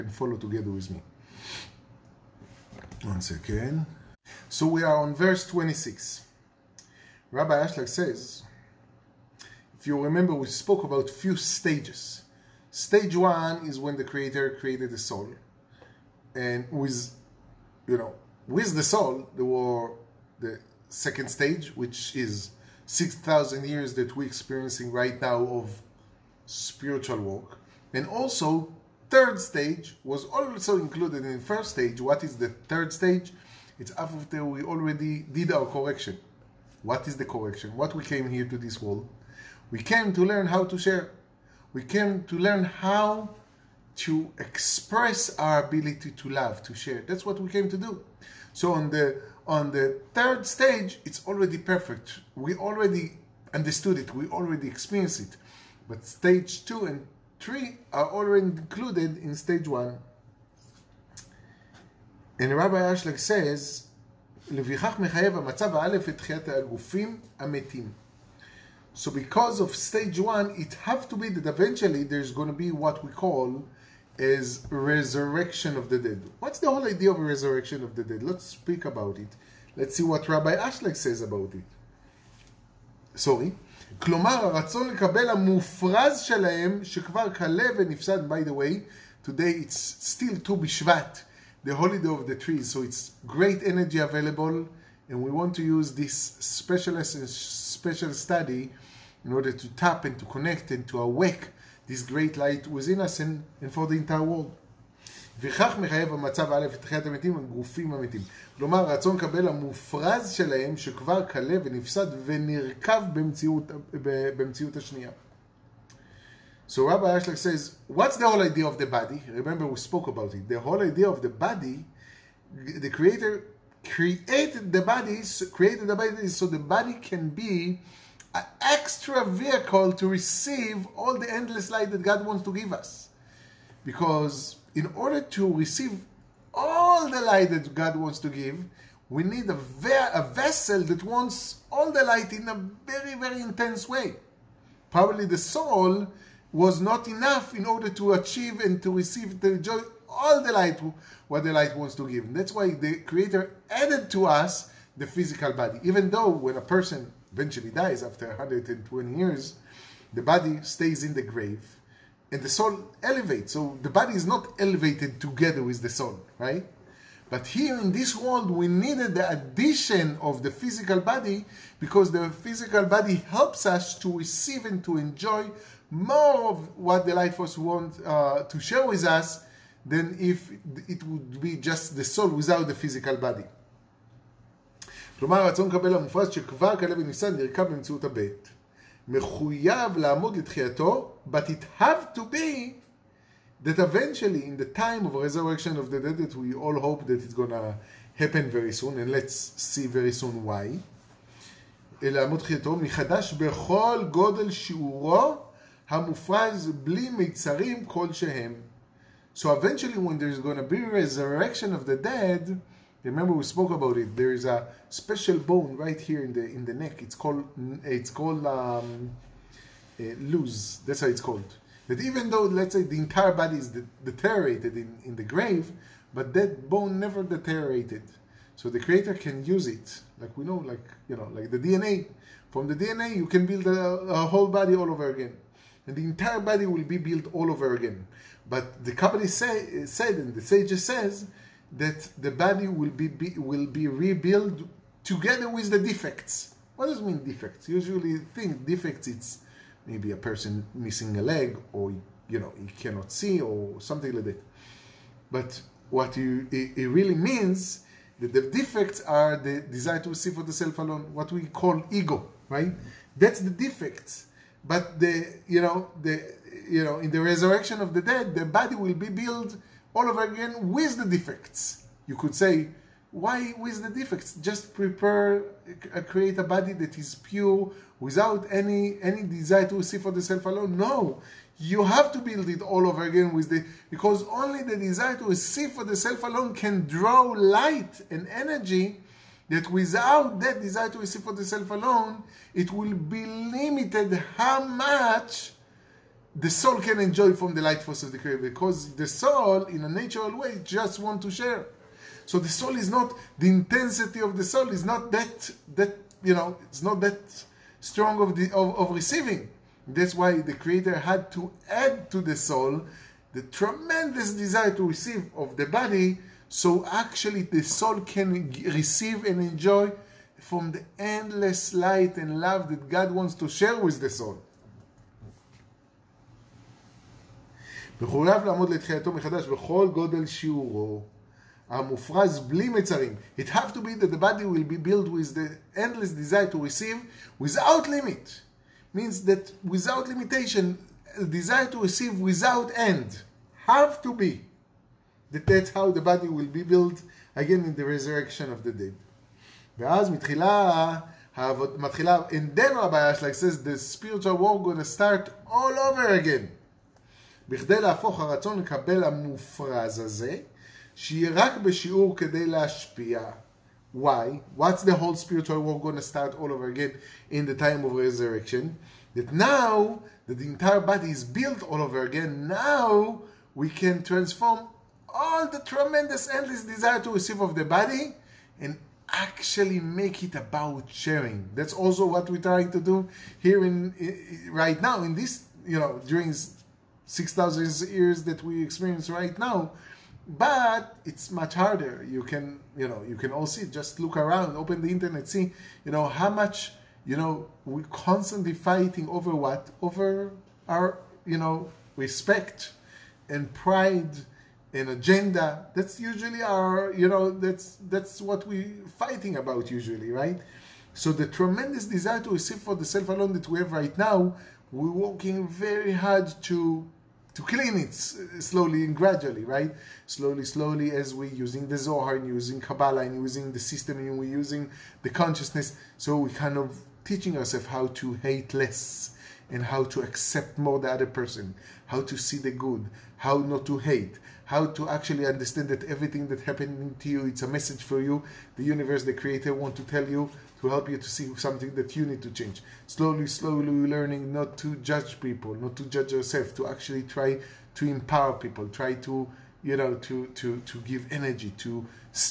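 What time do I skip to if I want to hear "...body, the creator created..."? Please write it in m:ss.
2:01.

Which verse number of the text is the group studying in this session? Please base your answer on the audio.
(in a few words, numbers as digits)
26.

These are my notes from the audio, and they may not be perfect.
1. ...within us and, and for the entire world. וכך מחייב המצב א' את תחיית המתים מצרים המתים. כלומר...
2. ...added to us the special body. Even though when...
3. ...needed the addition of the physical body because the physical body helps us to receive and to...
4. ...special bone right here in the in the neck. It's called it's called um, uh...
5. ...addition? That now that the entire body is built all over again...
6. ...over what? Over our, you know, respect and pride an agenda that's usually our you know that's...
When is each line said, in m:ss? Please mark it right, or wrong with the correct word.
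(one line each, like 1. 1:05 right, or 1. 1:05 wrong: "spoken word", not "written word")
1. 1:42 wrong: "הגופים", not "מצרים"
2. 2:33 wrong: "physical", not "special"
3. 2:48 right
4. 3:34 right
5. 6:07 wrong: "resurrection", not "addition"
6. 6:39 right.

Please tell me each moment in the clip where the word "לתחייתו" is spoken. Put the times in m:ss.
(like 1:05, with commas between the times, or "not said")
3:10, 5:28.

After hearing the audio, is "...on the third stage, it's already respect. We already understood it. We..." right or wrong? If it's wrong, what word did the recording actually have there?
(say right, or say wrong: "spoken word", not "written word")
wrong: "perfect", not "respect".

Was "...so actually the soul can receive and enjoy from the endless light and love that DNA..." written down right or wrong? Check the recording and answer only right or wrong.
wrong.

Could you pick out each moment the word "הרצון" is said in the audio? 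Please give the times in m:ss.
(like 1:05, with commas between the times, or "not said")
1:24, 3:05, 5:58.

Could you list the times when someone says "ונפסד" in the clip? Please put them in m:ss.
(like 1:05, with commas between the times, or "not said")
1:27, 1:51.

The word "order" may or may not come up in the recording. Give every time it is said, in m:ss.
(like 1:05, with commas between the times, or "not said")
1:39, 2:14, 2:27.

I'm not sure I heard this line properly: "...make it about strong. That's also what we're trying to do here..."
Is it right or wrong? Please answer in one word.
wrong.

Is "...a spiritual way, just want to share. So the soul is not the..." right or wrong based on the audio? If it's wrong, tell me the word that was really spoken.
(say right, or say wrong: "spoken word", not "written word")
wrong: "natural", not "spiritual".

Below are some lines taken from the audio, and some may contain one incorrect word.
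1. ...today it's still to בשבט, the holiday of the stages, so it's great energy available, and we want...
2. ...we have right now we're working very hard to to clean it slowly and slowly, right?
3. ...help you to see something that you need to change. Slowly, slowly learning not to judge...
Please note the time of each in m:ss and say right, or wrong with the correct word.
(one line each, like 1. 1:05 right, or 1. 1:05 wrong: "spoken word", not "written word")
1. 1:29 wrong: "trees", not "stages"
2. 6:53 wrong: "gradually", not "slowly"
3. 7:20 right.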